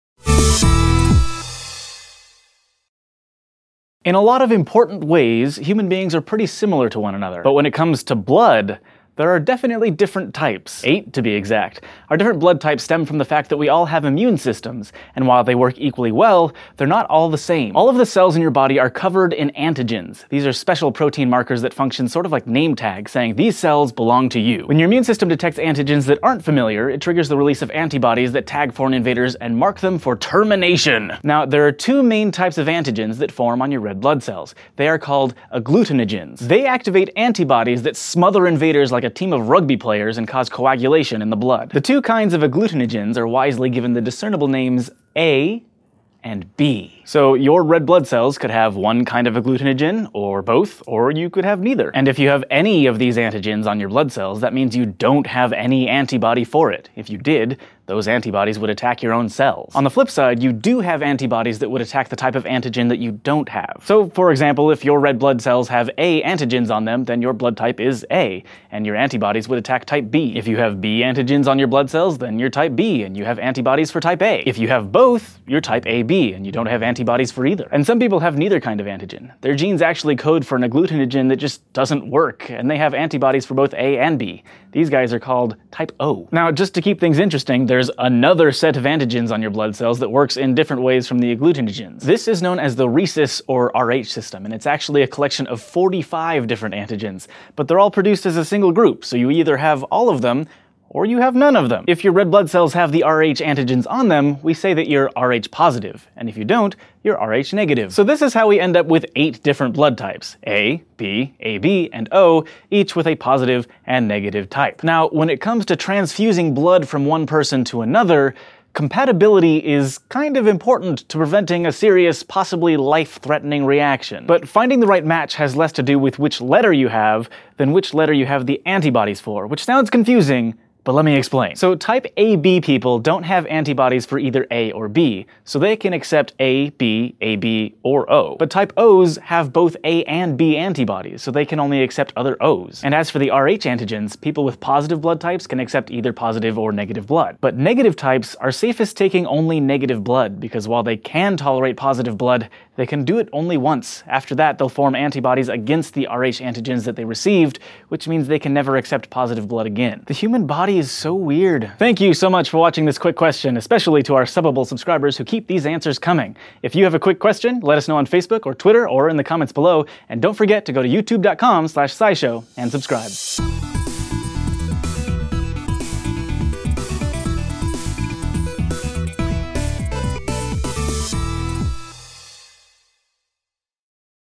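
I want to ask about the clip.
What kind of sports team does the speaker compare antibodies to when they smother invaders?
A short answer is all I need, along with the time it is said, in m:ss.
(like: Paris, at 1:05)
Rugby players, at 0:39.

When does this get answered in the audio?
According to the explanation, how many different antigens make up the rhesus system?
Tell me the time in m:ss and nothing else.
1:35.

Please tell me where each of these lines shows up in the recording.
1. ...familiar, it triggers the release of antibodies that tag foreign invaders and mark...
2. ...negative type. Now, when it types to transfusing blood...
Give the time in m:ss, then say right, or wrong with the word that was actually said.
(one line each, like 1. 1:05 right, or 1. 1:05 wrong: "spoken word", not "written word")
1. 0:26 right
2. 1:54 wrong: "comes", not "types".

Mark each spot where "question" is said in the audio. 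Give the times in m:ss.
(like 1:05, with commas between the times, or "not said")
2:43, 2:47.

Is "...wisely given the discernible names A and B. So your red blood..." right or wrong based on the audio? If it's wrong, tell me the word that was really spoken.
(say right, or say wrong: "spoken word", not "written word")
right.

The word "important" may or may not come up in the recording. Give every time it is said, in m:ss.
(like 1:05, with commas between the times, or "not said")
0:04, 2:00.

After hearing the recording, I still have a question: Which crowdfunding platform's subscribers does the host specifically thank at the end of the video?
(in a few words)
Subbable.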